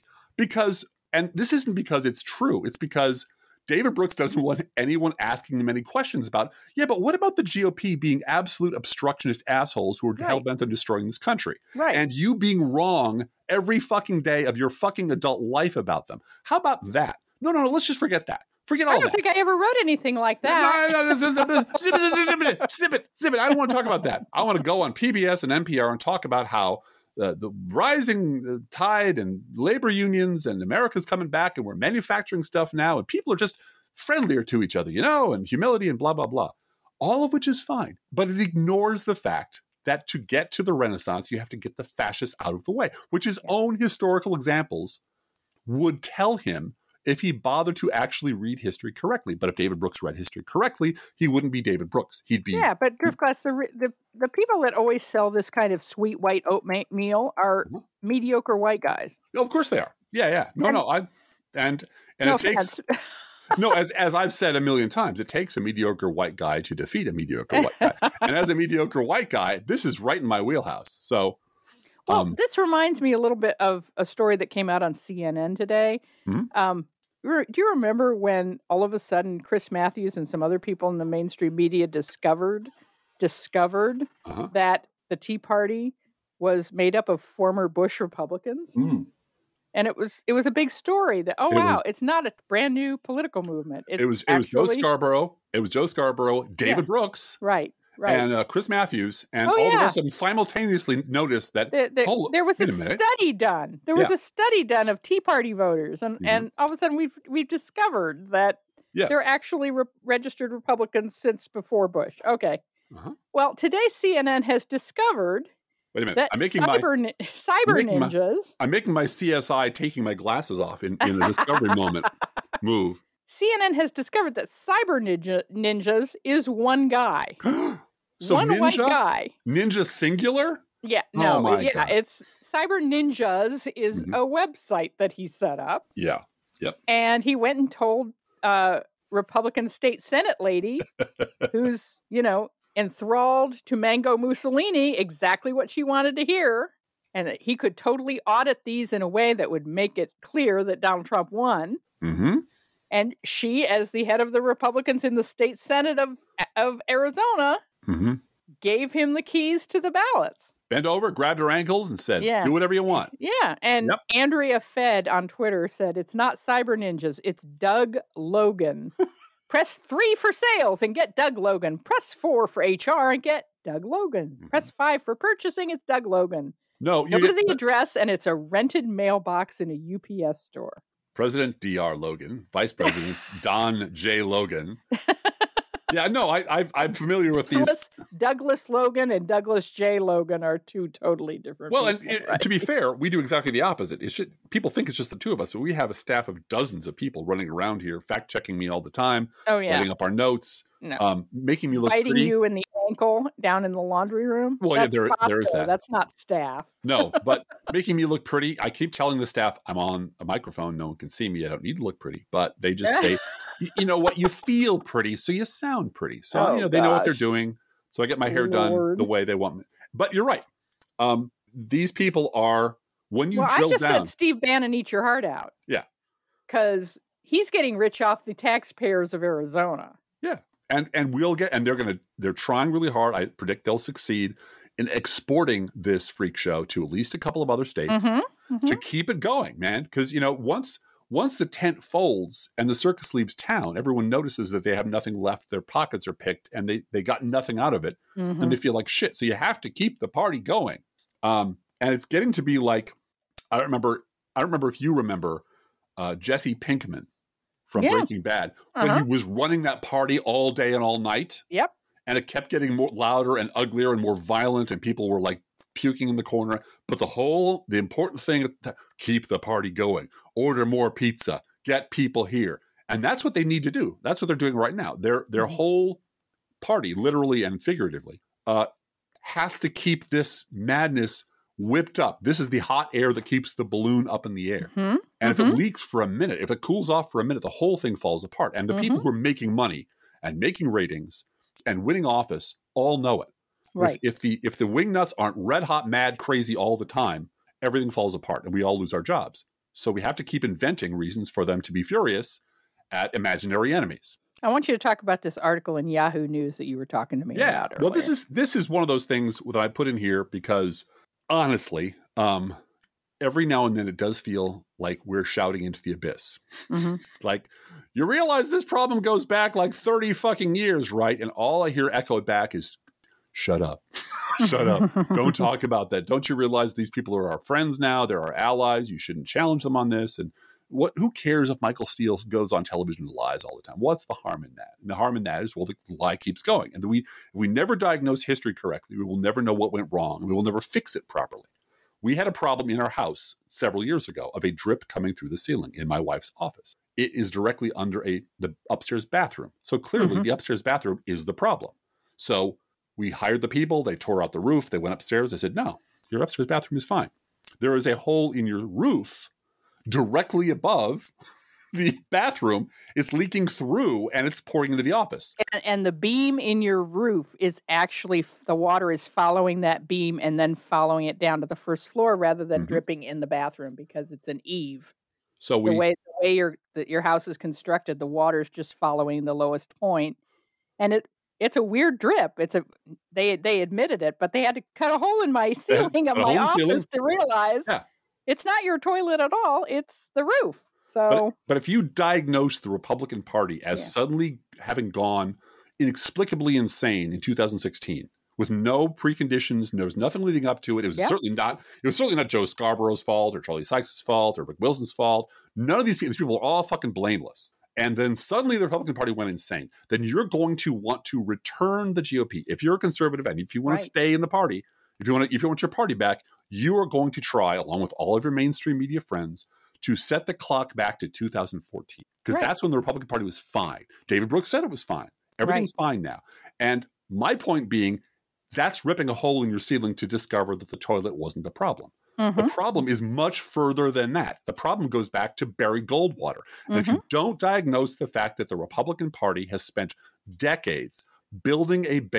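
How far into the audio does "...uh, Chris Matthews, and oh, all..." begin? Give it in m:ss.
1:38.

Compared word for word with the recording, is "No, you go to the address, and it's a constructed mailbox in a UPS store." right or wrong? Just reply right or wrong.
wrong.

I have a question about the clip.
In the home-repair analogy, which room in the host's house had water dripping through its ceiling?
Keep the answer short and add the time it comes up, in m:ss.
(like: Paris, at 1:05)
Wife's office, at 5:45.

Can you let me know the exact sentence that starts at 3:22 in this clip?
you in the ankle down in the laundry room.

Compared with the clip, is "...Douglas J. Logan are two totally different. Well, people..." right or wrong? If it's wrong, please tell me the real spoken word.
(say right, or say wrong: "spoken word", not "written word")
right.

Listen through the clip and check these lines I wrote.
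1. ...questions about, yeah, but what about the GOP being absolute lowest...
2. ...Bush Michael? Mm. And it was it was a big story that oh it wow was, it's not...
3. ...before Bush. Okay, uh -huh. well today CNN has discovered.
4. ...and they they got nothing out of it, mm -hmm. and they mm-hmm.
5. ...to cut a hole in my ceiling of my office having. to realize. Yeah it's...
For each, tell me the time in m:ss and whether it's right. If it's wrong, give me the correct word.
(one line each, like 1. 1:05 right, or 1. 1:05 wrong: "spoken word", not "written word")
1. 0:05 wrong: "obstructionist", not "lowest"
2. 1:27 wrong: "Republicans", not "Michael"
3. 1:51 right
4. 4:06 right
5. 6:24 wrong: "ceiling", not "having".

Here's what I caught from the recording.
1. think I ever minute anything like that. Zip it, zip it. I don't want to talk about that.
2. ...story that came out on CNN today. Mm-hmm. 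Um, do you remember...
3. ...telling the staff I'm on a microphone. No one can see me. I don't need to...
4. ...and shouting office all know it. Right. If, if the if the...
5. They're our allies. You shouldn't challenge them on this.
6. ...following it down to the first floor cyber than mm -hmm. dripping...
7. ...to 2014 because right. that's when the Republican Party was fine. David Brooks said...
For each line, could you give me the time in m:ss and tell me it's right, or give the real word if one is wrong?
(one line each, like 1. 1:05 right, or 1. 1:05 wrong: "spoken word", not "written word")
1. 0:19 wrong: "wrote", not "minute"
2. 1:14 right
3. 3:28 right
4. 4:51 wrong: "winning", not "shouting"
5. 5:28 right
6. 6:10 wrong: "rather", not "cyber"
7. 7:00 right.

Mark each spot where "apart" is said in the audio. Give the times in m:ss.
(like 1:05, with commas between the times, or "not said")
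4:48, 4:58.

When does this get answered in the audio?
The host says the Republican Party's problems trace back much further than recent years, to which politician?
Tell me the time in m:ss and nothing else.
7:15.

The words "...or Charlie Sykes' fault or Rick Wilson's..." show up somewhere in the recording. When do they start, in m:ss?
6:43.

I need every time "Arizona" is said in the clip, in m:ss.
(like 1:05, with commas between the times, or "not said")
2:36, 3:49.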